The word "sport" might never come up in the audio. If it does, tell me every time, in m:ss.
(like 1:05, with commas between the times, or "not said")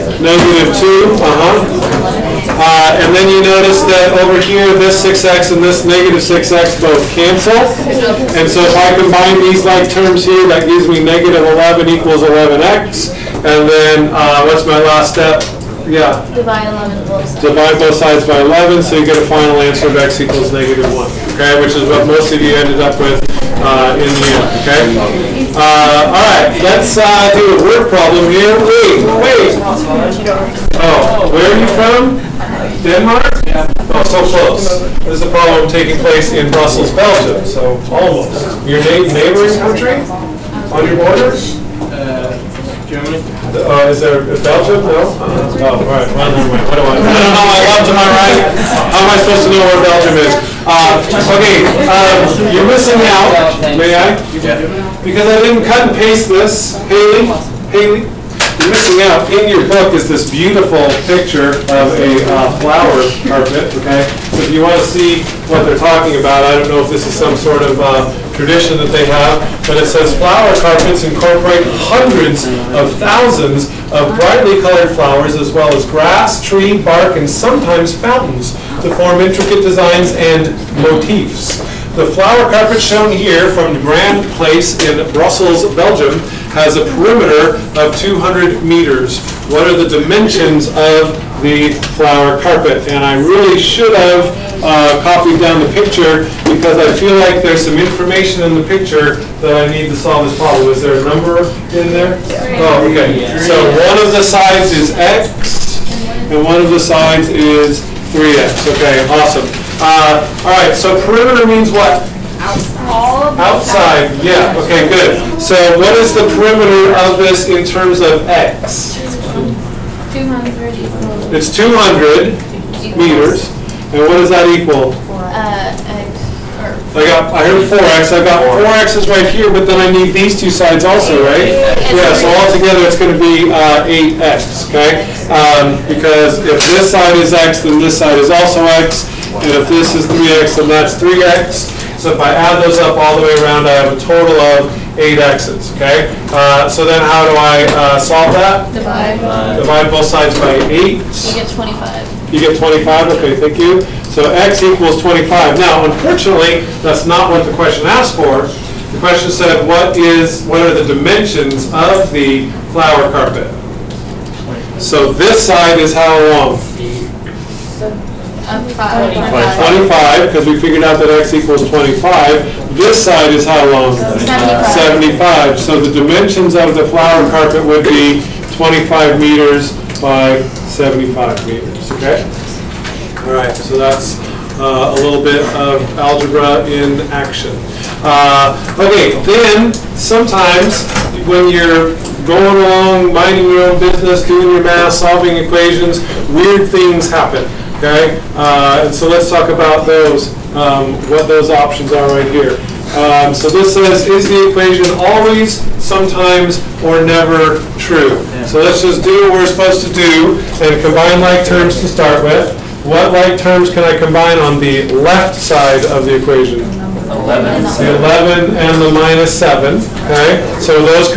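not said.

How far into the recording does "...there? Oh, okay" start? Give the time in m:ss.
1:41.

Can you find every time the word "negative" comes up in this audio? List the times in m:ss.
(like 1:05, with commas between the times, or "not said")
0:00, 0:05, 0:11, 0:20.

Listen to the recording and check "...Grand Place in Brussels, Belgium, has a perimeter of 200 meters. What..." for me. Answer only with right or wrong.
right.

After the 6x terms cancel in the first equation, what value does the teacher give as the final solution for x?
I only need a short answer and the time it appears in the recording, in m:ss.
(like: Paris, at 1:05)
x = -1, at 0:19.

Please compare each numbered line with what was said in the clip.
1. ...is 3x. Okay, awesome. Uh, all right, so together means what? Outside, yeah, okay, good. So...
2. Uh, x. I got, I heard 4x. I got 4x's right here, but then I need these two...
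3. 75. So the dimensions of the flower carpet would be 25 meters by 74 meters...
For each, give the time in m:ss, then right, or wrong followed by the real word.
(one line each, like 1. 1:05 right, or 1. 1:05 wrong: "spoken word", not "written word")
1. 1:47 wrong: "perimeter", not "together"
2. 2:05 right
3. 2:55 wrong: "75", not "74".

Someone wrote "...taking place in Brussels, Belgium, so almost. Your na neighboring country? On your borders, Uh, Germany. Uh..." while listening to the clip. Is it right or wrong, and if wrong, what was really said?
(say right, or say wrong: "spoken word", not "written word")
right.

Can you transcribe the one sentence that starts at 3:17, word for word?
Okay, uh, and so let's talk about those, um, what those options are right here.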